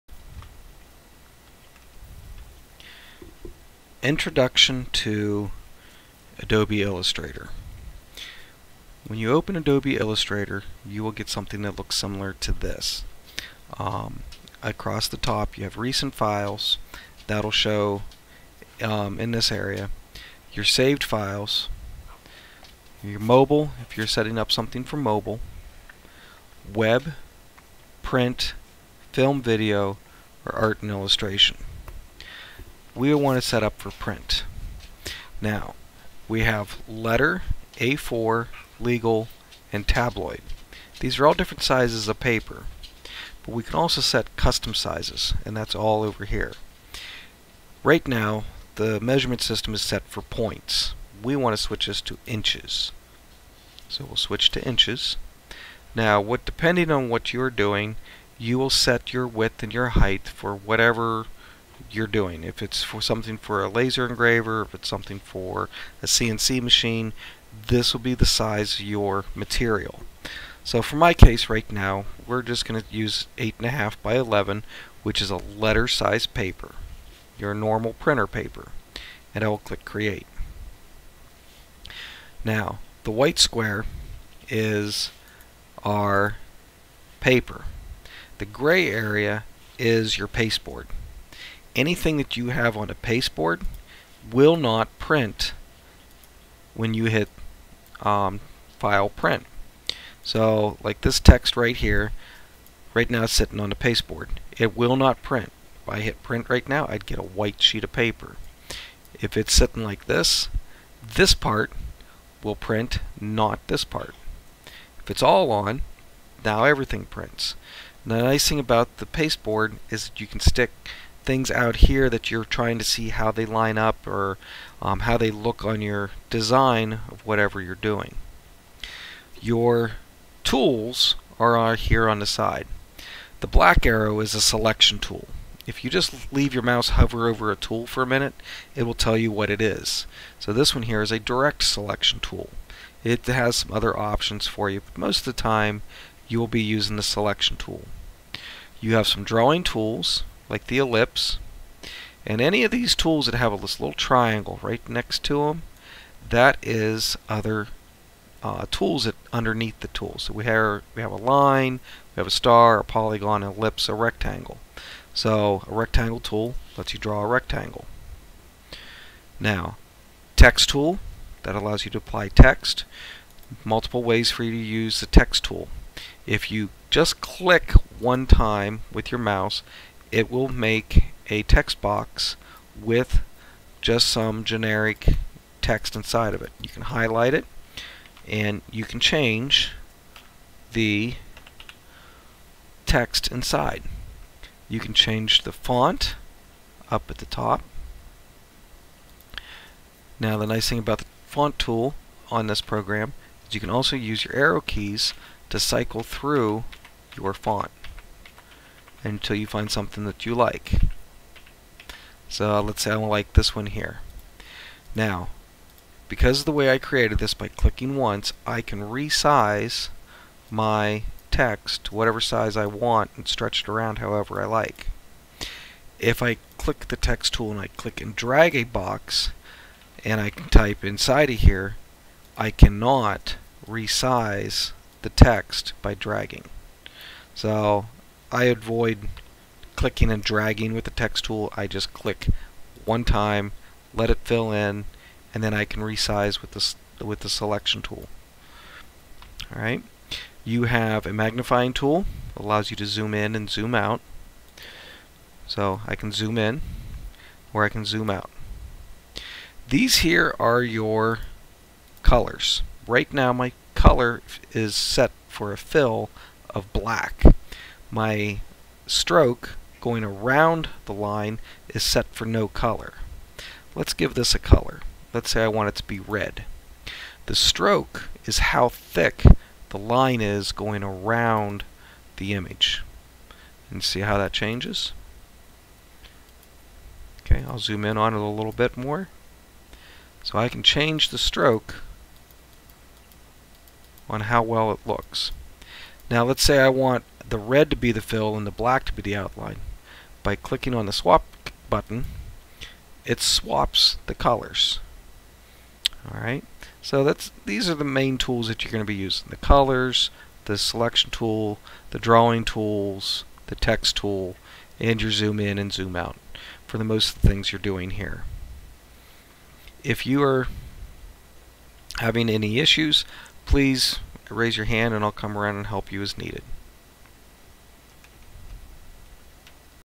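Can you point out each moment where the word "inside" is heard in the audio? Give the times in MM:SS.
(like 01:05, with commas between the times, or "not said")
03:05, 03:13, 03:50.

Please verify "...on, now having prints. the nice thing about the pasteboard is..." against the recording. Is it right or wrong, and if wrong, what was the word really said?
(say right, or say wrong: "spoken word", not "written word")
wrong: "everything", not "having".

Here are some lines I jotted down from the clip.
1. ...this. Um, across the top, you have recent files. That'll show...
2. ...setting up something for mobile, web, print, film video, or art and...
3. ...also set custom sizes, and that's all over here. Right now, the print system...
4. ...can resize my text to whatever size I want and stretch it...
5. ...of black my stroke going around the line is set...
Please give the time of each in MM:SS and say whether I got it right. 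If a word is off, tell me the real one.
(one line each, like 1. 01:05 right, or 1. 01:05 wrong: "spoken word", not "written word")
1. 00:12 right
2. 00:24 right
3. 00:43 wrong: "measurement", not "print"
4. 03:38 right
5. 04:26 right.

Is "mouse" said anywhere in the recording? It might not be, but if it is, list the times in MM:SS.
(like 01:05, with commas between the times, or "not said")
02:16, 02:59.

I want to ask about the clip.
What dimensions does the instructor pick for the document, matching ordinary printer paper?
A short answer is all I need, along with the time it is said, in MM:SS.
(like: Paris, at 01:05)
8.5 by 11, at 01:13.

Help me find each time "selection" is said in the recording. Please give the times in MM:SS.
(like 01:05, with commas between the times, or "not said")
02:14, 02:21, 02:27, 04:07, 05:10.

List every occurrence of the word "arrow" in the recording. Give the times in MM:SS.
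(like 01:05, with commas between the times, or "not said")
02:13, 03:24.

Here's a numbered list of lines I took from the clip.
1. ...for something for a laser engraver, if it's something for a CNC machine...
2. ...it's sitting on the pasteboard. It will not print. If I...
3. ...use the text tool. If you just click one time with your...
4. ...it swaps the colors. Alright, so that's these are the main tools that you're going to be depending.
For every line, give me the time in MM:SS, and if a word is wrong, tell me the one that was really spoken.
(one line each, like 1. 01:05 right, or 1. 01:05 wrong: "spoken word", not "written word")
1. 01:02 right
2. 01:43 right
3. 02:54 right
4. 05:03 wrong: "using", not "depending".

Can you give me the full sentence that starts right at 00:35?
Now, we have letter, A4, legal, and tabloid.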